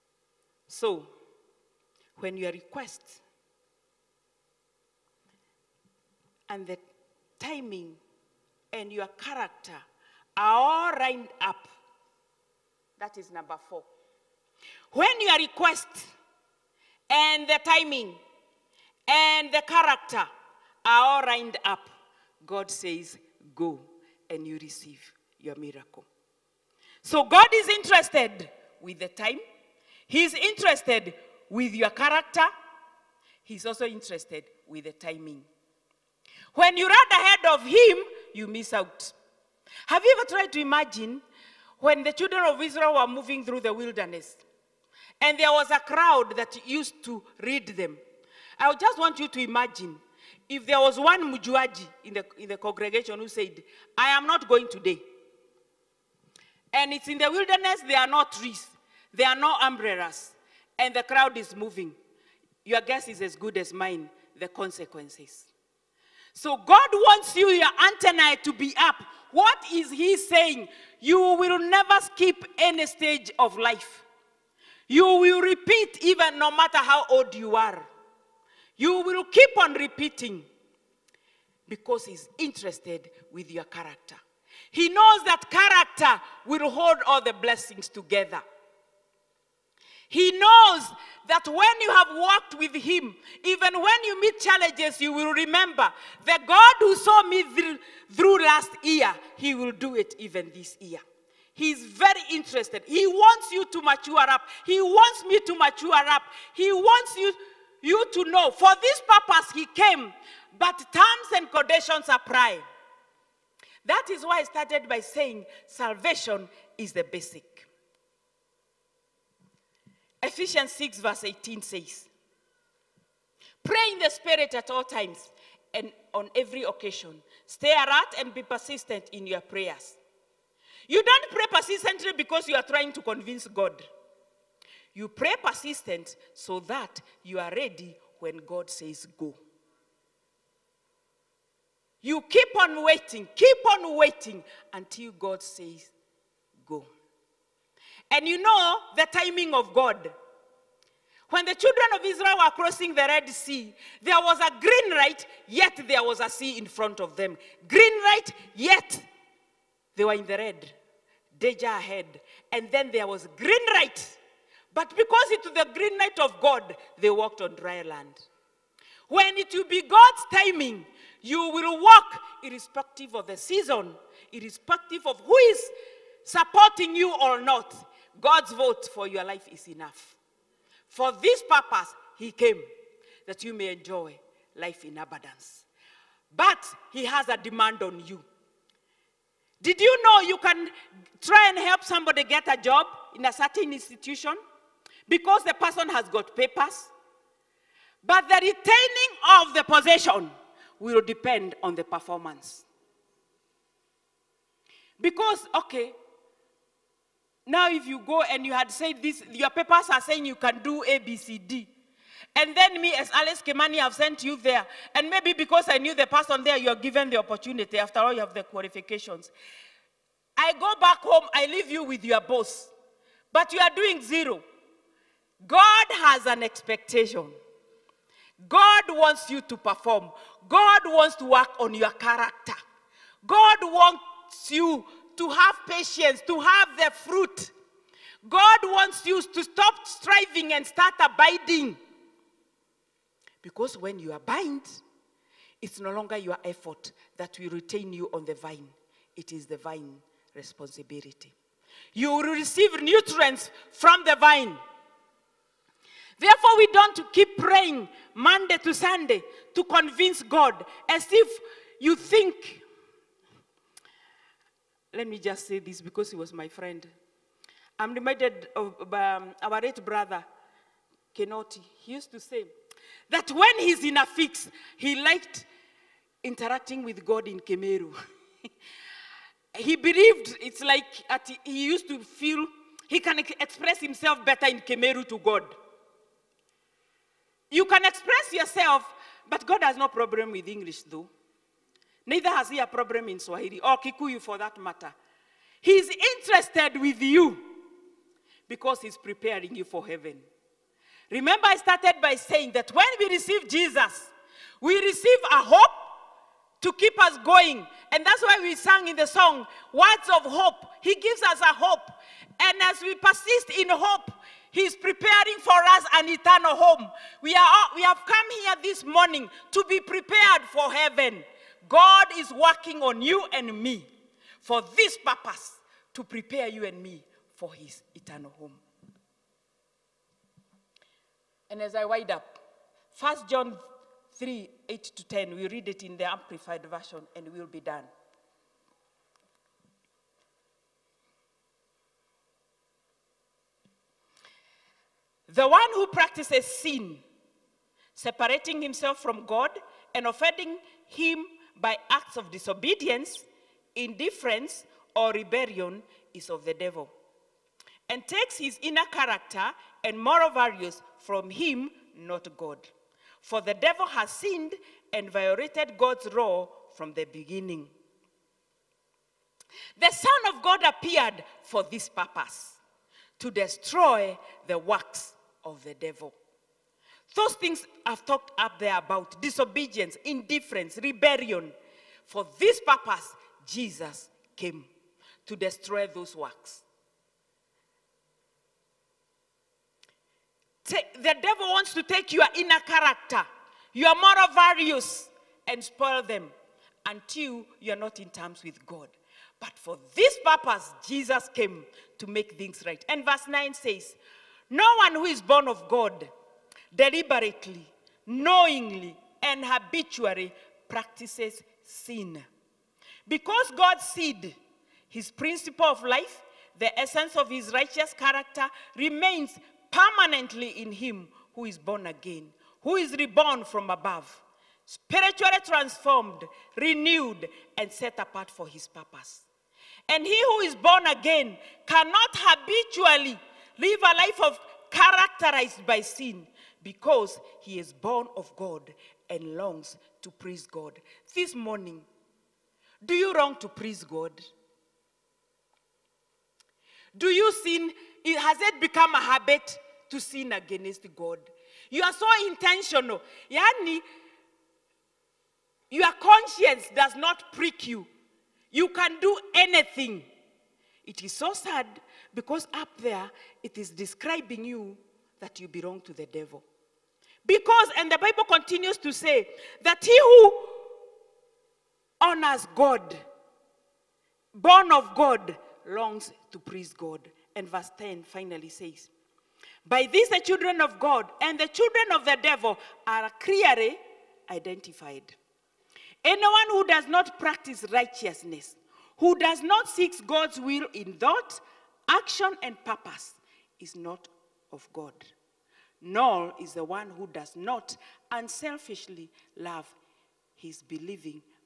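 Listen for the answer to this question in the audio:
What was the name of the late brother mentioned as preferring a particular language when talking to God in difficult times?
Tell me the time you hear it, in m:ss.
4:31.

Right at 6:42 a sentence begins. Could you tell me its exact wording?
And verse 9 says, No one who is born of God deliberately, knowingly, and habitually practices sin.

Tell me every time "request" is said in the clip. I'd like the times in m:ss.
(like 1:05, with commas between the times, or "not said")
0:02, 0:15.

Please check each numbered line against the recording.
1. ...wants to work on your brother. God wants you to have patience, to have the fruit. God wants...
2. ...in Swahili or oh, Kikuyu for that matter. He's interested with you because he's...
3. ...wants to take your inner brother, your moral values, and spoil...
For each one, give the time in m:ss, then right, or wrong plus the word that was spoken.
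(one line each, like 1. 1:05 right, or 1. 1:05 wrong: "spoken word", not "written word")
1. 3:50 wrong: "character", not "brother"
2. 4:53 right
3. 6:31 wrong: "character", not "brother".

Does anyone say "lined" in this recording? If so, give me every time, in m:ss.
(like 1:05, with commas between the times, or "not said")
0:10, 0:21.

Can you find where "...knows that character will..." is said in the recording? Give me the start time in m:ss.
1:24.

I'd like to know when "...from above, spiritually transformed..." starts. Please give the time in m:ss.
7:03.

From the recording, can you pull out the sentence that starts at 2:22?
You keep on waiting, keep on waiting until God says go.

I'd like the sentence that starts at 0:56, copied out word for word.
And it's in the wilderness, there are no trees.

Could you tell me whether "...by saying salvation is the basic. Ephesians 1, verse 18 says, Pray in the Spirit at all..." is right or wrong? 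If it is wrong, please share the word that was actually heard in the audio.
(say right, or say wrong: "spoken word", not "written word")
wrong: "6", not "1".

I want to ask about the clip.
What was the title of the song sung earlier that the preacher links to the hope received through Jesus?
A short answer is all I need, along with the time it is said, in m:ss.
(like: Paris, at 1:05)
Words of Hope, at 5:09.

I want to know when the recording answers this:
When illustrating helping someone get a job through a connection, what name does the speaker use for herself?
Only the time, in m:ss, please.
3:33.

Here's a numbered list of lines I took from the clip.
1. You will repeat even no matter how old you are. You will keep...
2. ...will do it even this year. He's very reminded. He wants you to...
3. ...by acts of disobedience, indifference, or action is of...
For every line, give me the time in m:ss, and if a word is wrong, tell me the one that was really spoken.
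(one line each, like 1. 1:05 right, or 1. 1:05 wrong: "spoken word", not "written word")
1. 1:14 right
2. 1:39 wrong: "interested", not "reminded"
3. 5:51 wrong: "rebellion", not "action".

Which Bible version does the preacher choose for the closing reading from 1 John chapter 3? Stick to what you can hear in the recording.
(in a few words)
Amplified Version.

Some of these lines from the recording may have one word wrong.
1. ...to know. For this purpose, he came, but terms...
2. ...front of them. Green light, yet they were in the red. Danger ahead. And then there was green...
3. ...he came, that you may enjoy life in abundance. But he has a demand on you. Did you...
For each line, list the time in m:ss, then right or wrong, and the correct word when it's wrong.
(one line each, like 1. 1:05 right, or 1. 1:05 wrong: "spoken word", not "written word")
1. 1:48 right
2. 2:36 right
3. 3:02 right.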